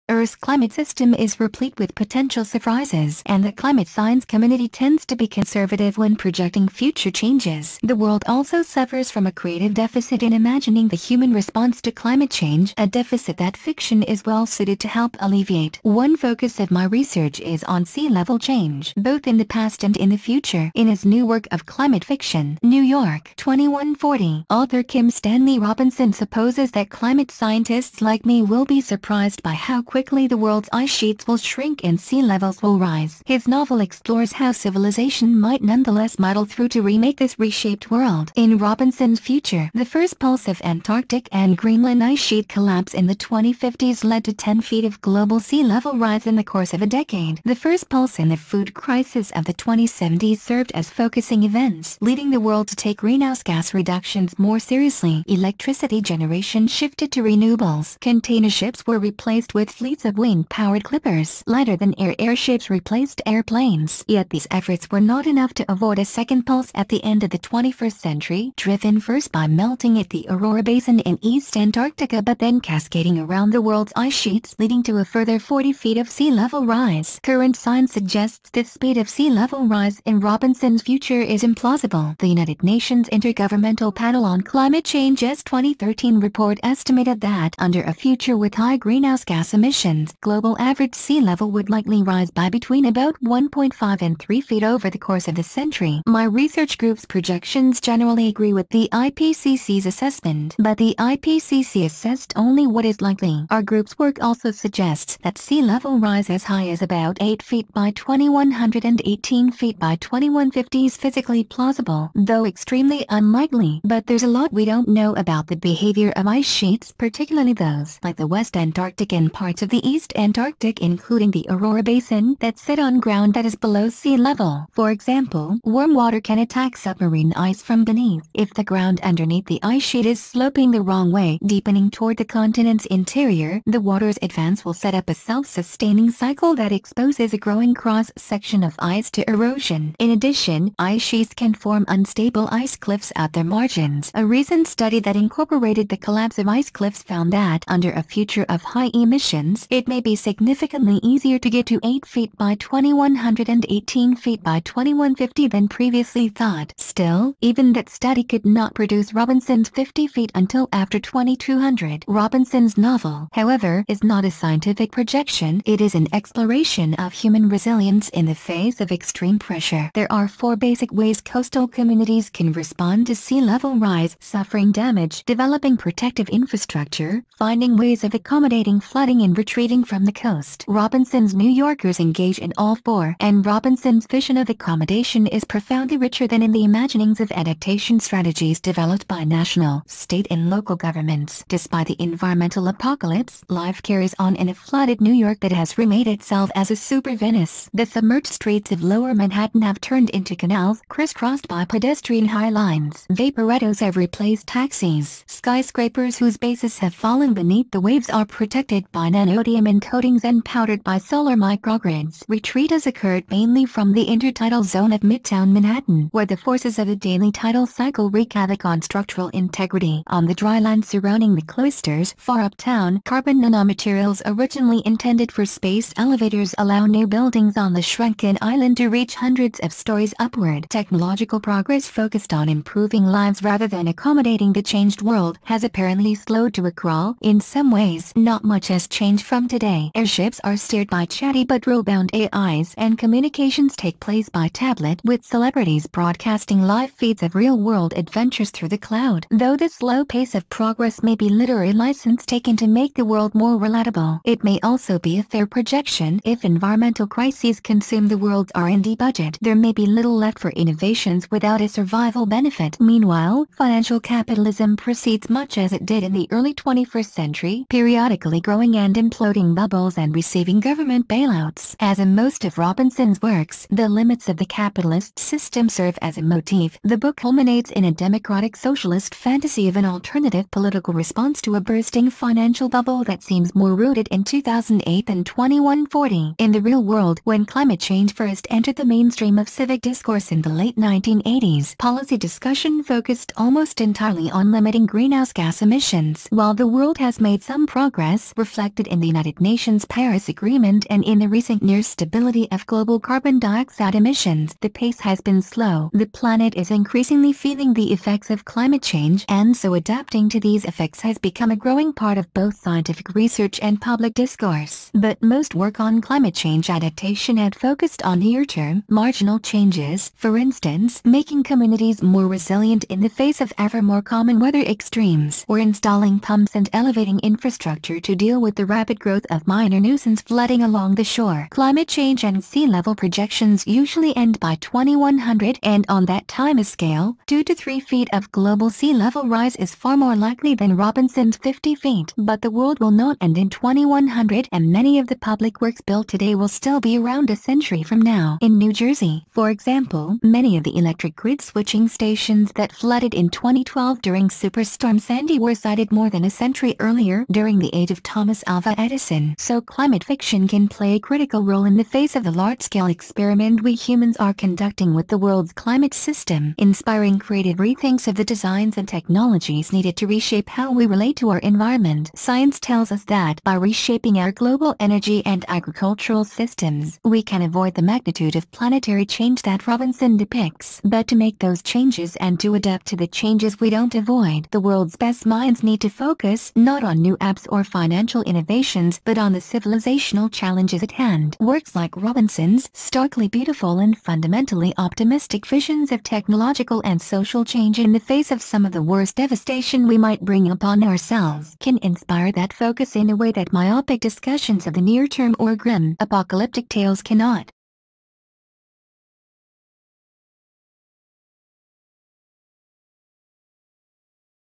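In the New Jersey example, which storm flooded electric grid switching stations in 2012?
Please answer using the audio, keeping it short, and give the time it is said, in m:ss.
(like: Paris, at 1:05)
Superstorm Sandy, at 5:54.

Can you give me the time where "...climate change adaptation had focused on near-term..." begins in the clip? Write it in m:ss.
5:15.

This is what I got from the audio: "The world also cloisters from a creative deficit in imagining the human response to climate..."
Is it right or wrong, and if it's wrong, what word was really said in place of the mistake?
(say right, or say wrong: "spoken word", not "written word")
wrong: "suffers", not "cloisters".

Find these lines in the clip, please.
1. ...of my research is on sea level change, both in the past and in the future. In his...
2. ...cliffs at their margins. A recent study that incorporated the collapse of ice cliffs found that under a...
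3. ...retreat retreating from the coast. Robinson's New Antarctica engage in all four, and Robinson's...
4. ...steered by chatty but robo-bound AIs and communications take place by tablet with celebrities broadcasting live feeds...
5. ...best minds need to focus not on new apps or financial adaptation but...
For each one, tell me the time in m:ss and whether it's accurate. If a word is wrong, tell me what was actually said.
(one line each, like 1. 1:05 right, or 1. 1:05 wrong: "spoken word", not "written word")
1. 0:16 right
2. 2:22 right
3. 2:59 wrong: "Yorkers", not "Antarctica"
4. 4:00 right
5. 6:24 wrong: "innovation", not "adaptation".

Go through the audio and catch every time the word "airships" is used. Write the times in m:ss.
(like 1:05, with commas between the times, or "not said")
1:02, 3:59.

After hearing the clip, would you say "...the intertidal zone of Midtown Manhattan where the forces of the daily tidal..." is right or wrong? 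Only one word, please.
right.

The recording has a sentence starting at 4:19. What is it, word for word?
There may be little left for innovations without a survival benefit.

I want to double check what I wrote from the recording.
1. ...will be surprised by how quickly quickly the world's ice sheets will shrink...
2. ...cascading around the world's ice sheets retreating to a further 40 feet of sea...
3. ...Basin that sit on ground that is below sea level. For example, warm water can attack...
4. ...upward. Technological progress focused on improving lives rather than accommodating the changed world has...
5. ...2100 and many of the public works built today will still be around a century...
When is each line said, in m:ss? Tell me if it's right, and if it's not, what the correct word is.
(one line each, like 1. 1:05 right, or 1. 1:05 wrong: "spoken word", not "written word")
1. 0:28 right
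2. 1:12 wrong: "leading", not "retreating"
3. 2:01 right
4. 3:50 right
5. 5:43 right.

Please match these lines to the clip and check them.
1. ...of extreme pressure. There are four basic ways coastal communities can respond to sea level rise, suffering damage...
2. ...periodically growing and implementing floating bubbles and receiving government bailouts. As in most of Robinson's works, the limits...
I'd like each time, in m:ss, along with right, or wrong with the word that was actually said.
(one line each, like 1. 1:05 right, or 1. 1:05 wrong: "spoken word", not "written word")
1. 2:48 right
2. 4:27 right.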